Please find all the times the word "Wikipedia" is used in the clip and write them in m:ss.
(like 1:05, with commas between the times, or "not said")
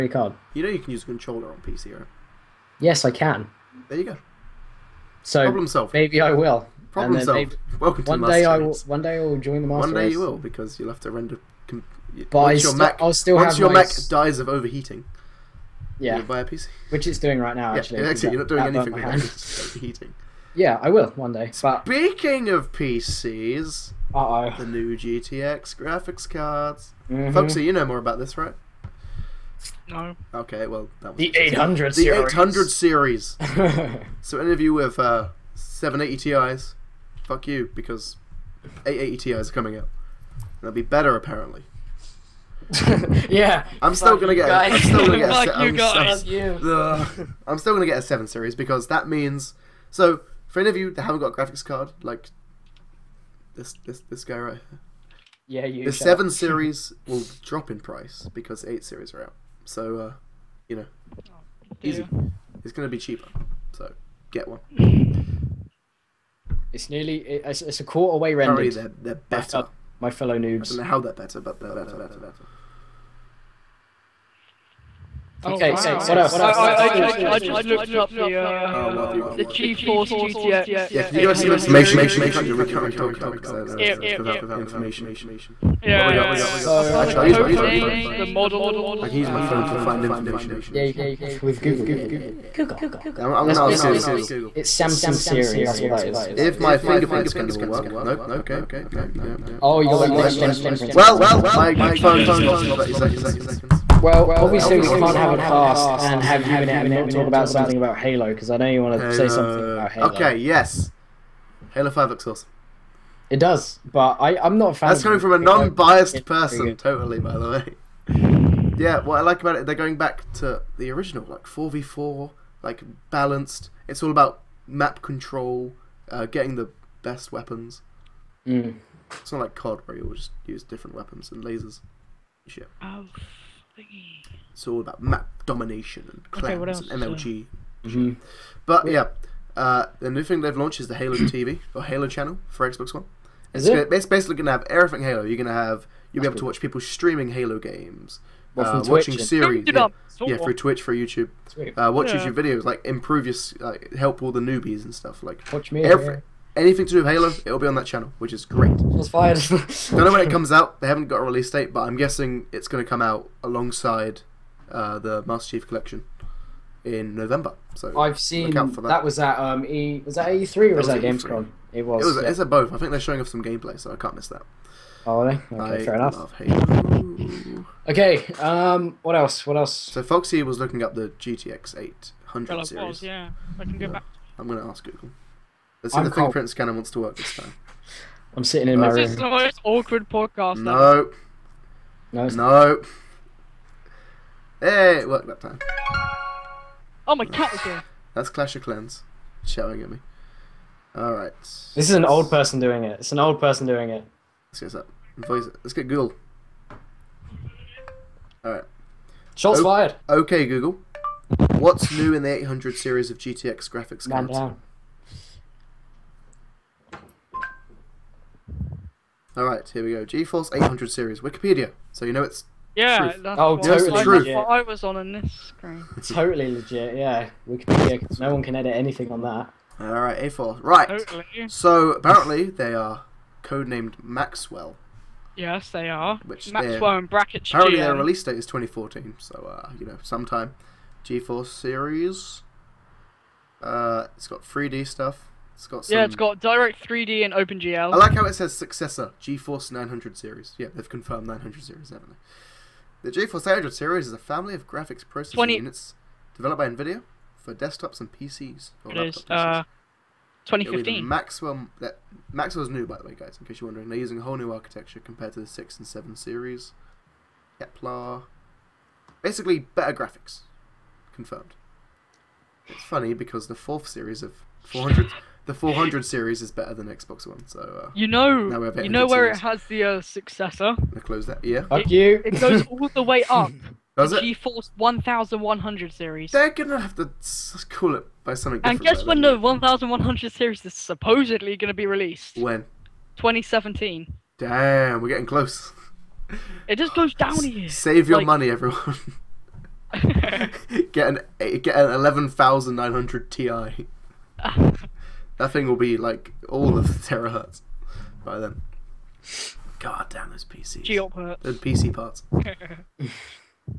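3:41, 3:47.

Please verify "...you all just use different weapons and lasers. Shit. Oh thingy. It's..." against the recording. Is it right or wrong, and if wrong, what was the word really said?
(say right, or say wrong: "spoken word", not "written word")
right.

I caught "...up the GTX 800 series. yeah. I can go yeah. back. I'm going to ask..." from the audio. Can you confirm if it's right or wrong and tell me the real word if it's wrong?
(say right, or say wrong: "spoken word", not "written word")
right.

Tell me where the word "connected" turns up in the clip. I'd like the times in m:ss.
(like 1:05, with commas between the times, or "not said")
not said.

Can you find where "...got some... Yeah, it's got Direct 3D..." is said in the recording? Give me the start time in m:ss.
4:05.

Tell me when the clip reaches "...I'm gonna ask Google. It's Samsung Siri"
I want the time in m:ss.
1:33.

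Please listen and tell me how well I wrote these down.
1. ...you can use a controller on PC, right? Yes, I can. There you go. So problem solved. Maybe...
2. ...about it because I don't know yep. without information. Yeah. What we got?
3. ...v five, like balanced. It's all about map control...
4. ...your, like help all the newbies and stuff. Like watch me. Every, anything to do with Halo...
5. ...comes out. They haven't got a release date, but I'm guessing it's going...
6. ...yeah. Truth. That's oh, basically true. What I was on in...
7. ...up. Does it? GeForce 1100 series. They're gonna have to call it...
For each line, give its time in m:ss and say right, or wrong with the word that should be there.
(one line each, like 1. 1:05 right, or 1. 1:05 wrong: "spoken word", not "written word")
1. 0:00 right
2. 1:23 right
3. 2:01 wrong: "four", not "five"
4. 2:33 right
5. 2:40 right
6. 3:42 wrong: "totally", not "basically"
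7. 4:43 right.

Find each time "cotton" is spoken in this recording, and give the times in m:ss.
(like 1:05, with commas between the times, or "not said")
not said.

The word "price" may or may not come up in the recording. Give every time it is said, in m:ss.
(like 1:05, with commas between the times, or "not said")
0:57.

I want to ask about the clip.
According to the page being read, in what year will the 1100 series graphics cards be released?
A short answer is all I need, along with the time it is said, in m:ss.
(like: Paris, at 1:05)
2017, at 4:53.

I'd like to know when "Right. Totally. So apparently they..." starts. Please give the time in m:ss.
3:50.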